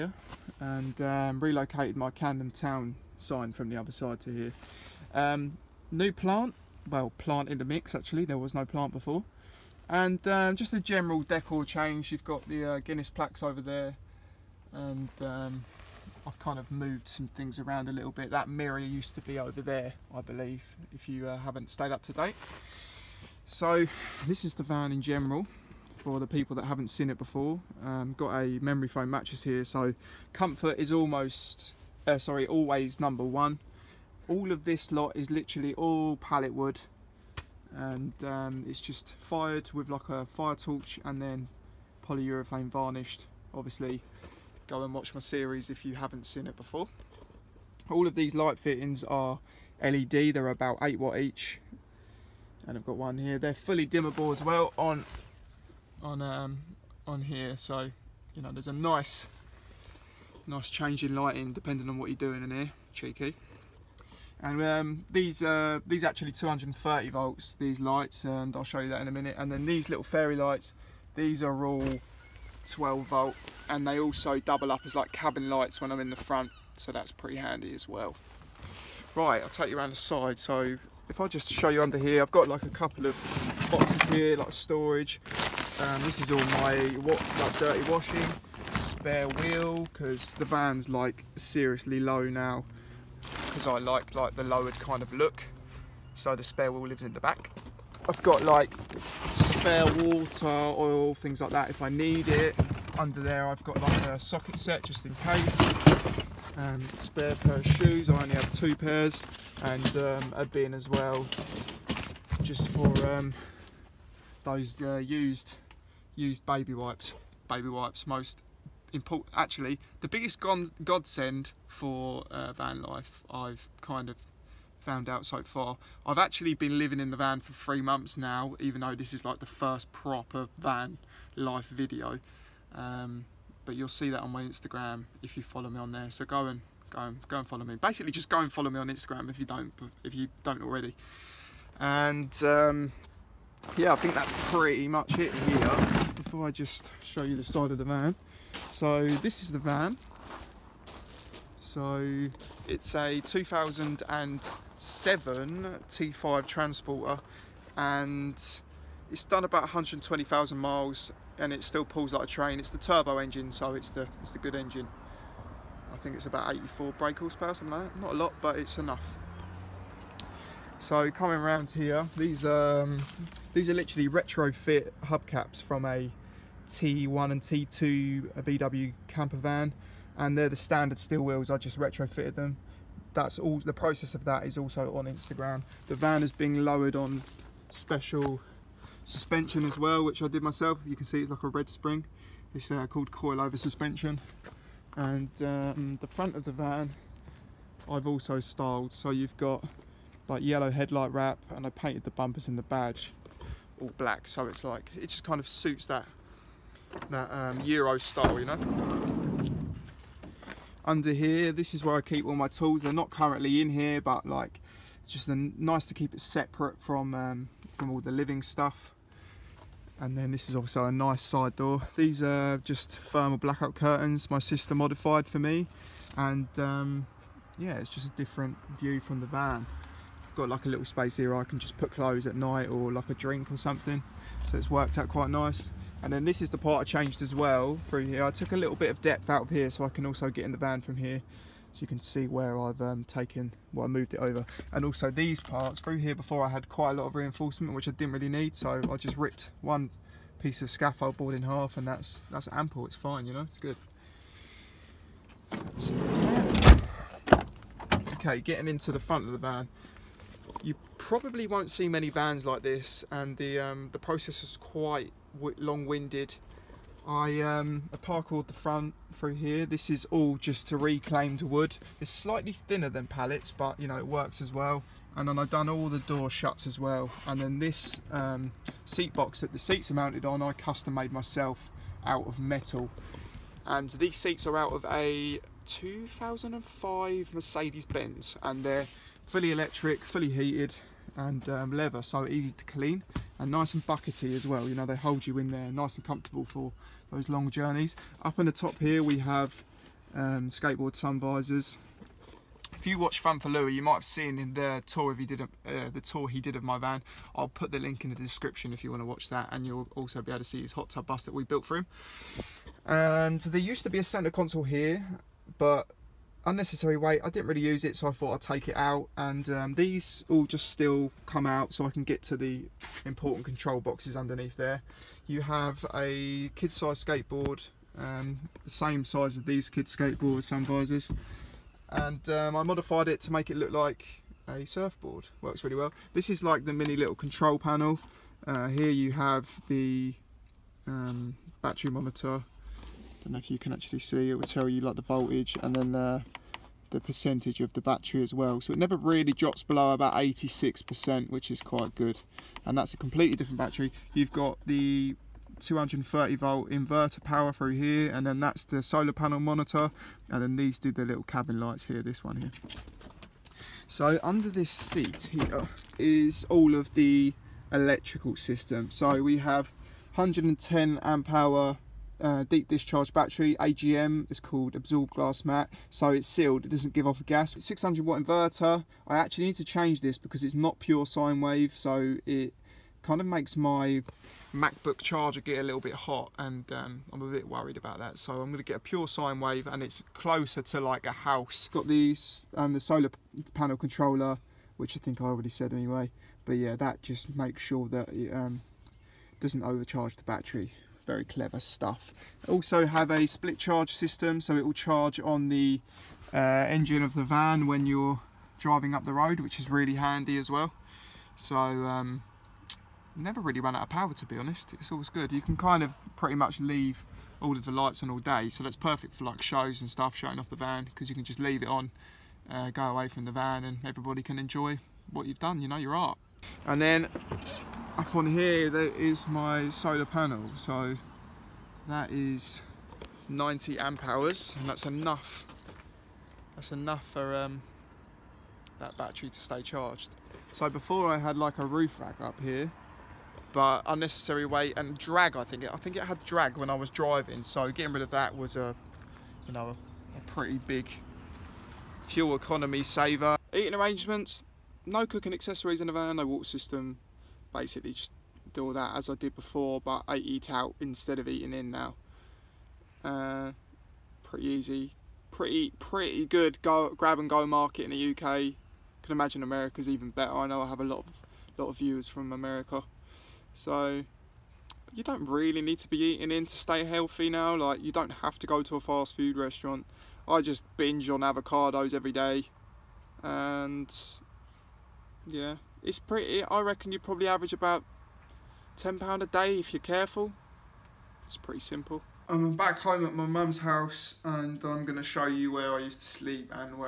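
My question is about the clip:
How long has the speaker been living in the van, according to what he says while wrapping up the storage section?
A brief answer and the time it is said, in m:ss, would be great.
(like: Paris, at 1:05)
3 months, at 2:07.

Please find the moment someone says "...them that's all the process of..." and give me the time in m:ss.
3:02.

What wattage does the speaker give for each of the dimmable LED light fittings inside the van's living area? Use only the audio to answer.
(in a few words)
8 watt.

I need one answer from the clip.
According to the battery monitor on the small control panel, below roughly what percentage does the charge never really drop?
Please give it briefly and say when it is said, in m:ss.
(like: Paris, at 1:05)
86%, at 5:50.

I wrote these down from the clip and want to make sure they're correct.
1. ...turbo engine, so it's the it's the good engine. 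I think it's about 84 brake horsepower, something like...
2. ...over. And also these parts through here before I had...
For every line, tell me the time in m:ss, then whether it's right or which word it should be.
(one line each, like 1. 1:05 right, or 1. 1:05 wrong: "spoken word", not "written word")
1. 2:42 right
2. 4:04 right.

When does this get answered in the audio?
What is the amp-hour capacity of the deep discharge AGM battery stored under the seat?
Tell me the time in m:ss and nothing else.
6:10.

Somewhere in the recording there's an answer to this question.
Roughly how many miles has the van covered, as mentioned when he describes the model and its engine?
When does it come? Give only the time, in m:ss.
2:39.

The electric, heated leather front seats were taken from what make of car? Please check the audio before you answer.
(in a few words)
Mercedes-Benz.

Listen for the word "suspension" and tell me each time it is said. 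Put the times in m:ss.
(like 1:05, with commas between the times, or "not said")
3:09, 3:13.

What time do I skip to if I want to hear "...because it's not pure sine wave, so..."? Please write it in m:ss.
6:20.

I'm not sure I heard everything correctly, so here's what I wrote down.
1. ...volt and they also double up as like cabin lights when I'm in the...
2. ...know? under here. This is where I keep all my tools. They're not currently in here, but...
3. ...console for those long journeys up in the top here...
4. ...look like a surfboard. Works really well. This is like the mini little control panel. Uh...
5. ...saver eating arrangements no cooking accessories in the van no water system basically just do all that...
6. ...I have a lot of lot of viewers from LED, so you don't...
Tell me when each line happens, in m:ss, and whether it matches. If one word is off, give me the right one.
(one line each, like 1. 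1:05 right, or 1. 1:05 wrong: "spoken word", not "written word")
1. 1:13 right
2. 3:28 right
3. 4:56 wrong: "comfortable", not "console"
4. 5:33 right
5. 7:32 right
6. 7:50 wrong: "America", not "LED".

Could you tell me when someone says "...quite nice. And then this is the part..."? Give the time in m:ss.
3:55.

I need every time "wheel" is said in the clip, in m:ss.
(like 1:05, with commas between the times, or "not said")
1:29, 1:36, 3:01.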